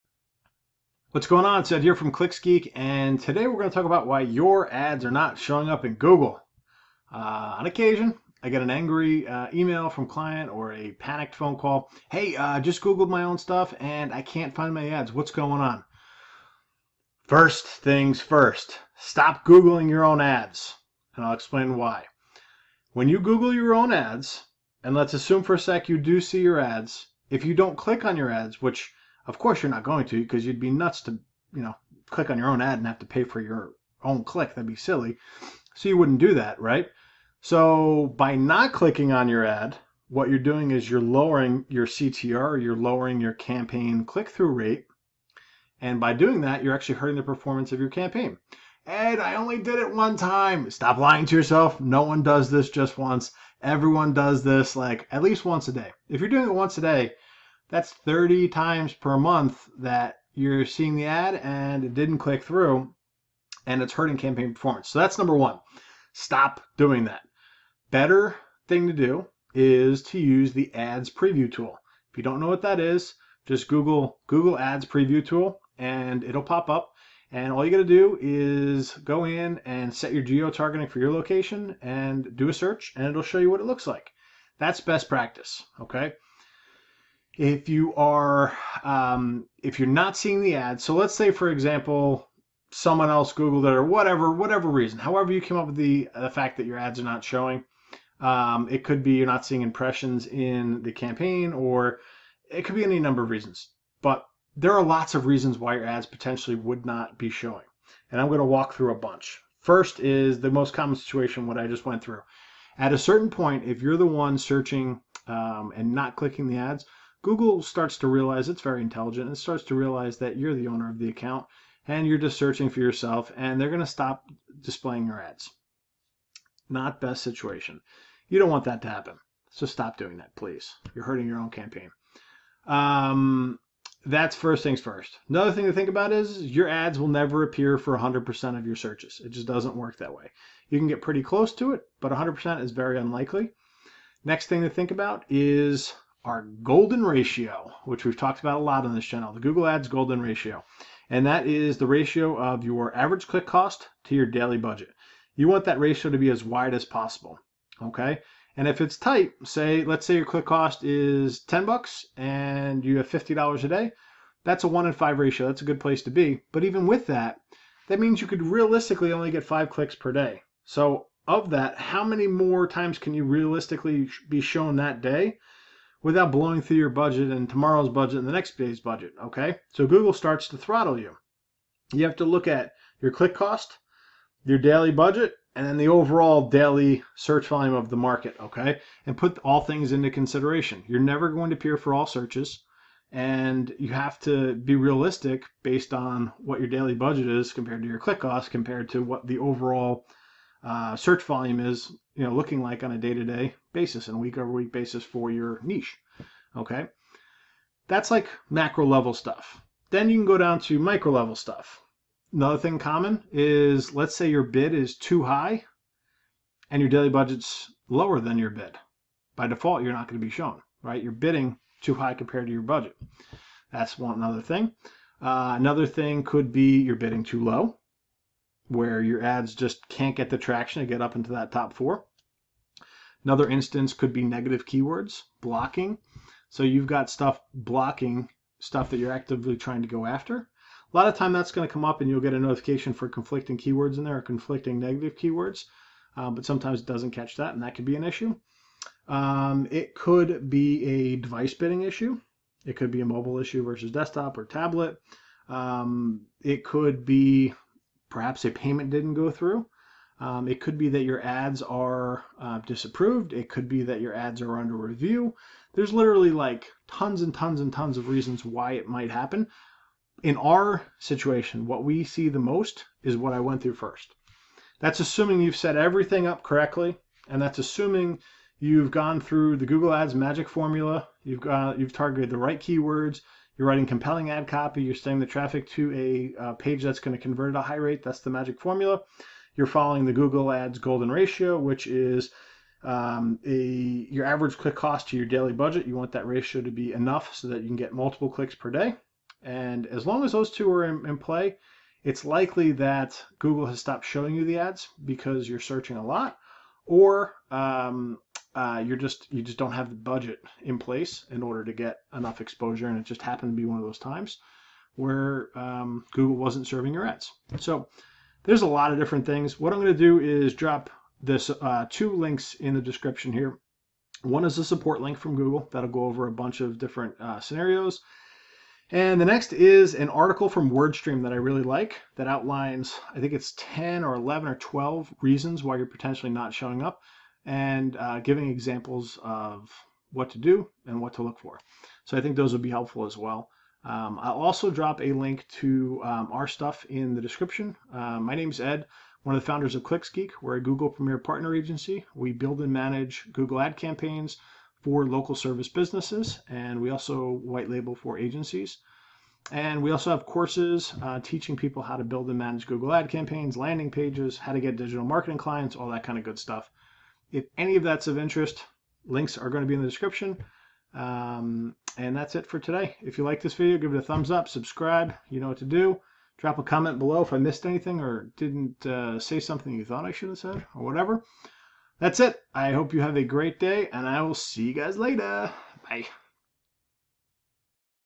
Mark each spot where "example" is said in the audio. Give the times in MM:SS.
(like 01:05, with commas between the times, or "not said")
01:31, 05:38.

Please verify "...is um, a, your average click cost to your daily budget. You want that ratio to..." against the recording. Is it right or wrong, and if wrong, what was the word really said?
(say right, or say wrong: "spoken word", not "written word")
right.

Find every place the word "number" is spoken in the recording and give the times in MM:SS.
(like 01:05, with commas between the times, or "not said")
01:05, 01:42.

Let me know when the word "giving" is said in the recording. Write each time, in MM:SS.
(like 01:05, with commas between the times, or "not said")
05:38.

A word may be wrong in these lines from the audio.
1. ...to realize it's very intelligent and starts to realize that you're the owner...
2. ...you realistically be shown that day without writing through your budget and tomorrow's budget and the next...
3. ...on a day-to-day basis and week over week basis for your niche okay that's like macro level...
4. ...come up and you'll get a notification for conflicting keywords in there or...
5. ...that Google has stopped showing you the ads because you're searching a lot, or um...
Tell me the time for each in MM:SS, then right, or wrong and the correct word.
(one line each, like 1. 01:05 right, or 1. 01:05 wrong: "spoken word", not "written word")
1. 01:57 right
2. 02:53 wrong: "blowing", not "writing"
3. 03:22 right
4. 04:01 right
5. 05:02 right.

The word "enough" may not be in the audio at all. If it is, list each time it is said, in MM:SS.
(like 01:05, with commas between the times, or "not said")
04:56, 05:12.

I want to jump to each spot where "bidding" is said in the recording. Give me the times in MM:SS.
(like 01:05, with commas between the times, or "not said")
03:41, 03:46, 04:11.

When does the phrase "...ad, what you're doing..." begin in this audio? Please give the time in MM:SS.
00:39.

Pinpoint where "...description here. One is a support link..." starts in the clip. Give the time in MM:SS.
05:22.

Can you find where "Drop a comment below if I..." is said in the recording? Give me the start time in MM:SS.
06:16.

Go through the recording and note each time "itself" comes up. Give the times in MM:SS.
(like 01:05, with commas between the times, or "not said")
not said.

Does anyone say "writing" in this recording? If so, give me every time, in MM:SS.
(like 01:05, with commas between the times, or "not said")
04:43.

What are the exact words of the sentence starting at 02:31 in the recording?
And that is the ratio of your average click cost to your daily budget.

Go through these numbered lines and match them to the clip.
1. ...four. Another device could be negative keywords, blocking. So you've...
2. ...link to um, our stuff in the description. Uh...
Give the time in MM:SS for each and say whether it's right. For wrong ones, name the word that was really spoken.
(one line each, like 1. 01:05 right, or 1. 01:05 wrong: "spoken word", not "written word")
1. 03:51 wrong: "instance", not "device"
2. 05:45 right.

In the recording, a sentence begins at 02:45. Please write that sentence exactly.
That's a good place to be.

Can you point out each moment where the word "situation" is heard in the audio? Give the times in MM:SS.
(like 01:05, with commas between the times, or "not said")
01:50, 02:07, 04:30.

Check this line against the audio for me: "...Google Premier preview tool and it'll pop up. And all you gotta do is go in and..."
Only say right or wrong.
wrong.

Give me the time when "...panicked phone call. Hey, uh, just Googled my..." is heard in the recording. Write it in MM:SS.
00:10.